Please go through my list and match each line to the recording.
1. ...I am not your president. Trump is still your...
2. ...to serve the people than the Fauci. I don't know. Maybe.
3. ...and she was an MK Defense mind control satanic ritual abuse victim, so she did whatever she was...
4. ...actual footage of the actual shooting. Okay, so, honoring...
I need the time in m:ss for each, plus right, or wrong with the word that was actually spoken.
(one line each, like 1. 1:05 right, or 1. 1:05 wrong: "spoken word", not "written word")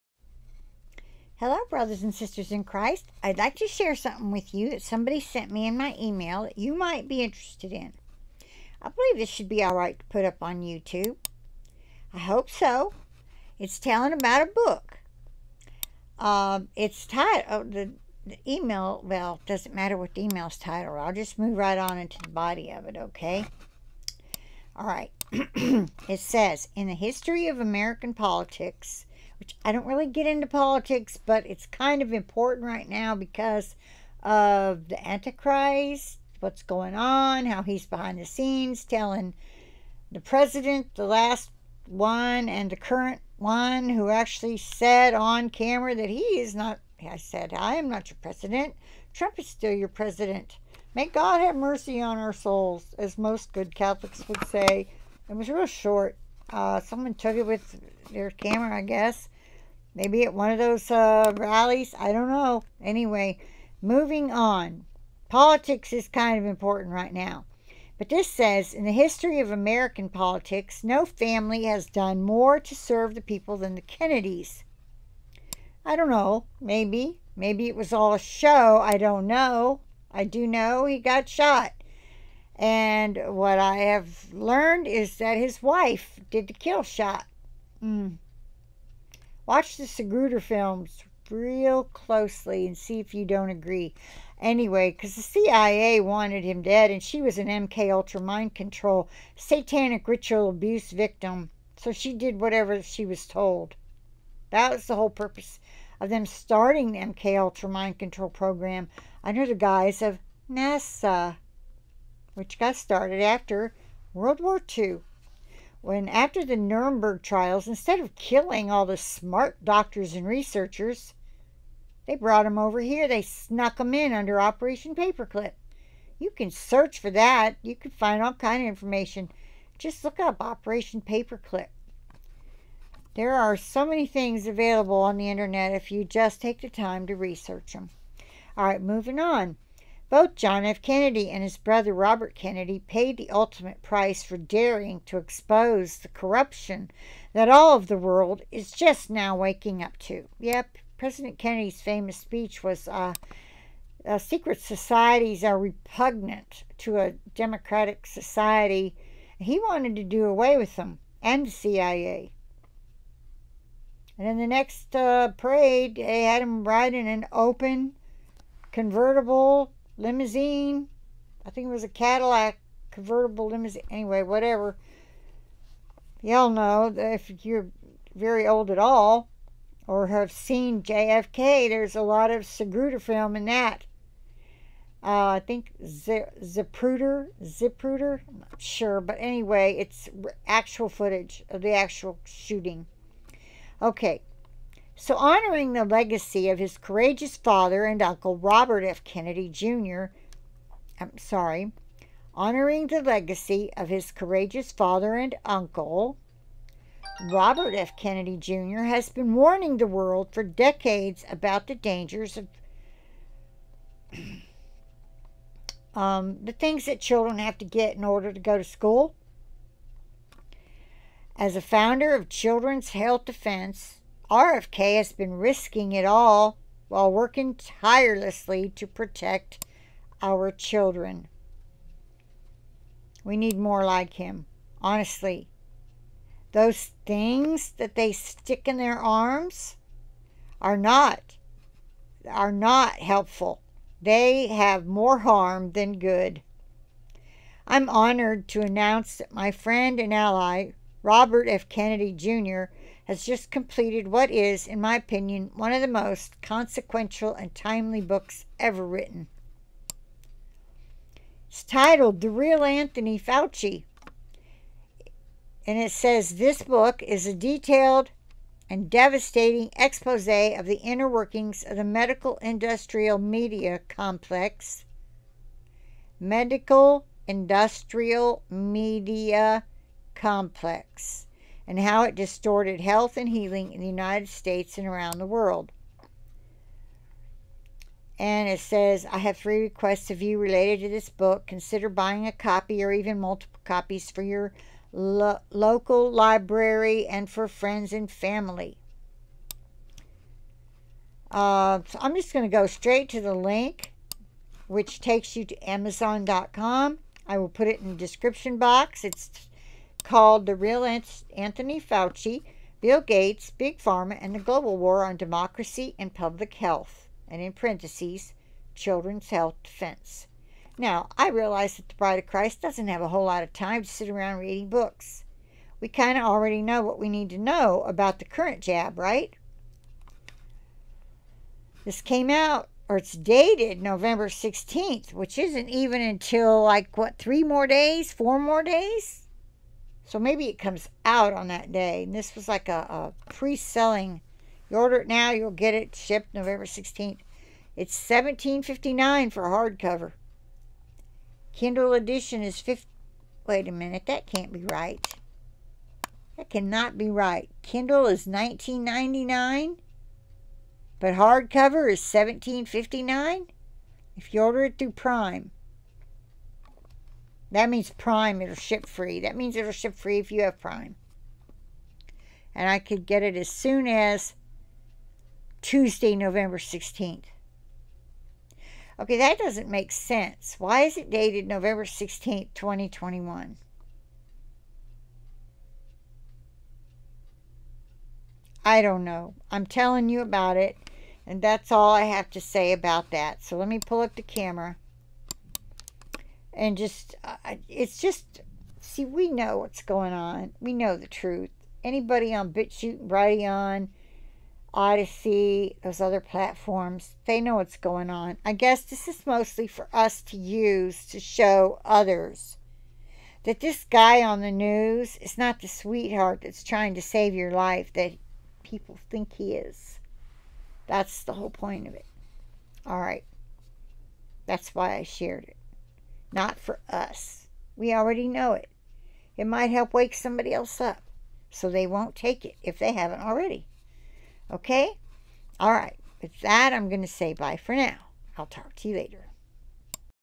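1. 0:47 right
2. 1:12 wrong: "Kennedys", not "Fauci"
3. 1:36 wrong: "Ultra", not "Defense"
4. 3:10 right.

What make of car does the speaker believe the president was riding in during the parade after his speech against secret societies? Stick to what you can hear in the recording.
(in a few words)
Cadillac.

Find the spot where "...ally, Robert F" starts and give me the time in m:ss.
4:10.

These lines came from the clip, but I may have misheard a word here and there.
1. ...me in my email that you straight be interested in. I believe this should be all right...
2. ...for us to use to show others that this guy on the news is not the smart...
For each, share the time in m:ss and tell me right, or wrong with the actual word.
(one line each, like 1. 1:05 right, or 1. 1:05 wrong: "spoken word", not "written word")
1. 0:05 wrong: "might", not "straight"
2. 6:49 wrong: "sweetheart", not "smart".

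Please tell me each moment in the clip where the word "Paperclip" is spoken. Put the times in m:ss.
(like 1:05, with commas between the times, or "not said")
2:04, 2:11.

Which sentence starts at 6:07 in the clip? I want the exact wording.
That means Prime, it'll ship free.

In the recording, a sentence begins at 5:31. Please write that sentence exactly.
This came out, or it's dated November 16th, which isn't even until like, what, three more days, four more days?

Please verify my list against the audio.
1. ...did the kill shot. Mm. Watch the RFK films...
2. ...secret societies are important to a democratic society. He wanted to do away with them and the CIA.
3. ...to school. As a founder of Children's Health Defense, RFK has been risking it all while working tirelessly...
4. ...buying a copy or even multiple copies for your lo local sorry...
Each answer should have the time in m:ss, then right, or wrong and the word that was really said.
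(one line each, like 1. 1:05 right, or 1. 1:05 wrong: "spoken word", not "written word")
1. 1:26 wrong: "Segruder", not "RFK"
2. 2:34 wrong: "repugnant", not "important"
3. 3:38 right
4. 4:51 wrong: "library", not "sorry".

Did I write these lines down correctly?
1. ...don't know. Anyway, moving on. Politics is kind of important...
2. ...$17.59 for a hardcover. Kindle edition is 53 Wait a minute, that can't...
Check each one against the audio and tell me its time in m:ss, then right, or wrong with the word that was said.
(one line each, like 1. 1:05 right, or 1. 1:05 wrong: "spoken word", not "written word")
1. 1:02 right
2. 5:48 wrong: "50", not "53".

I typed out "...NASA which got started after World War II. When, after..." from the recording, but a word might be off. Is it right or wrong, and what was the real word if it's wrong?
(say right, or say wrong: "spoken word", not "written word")
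right.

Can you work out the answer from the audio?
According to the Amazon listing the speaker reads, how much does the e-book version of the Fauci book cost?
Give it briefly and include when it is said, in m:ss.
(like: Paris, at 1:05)
$19.99, at 5:58.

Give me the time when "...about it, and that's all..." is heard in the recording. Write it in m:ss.
6:30.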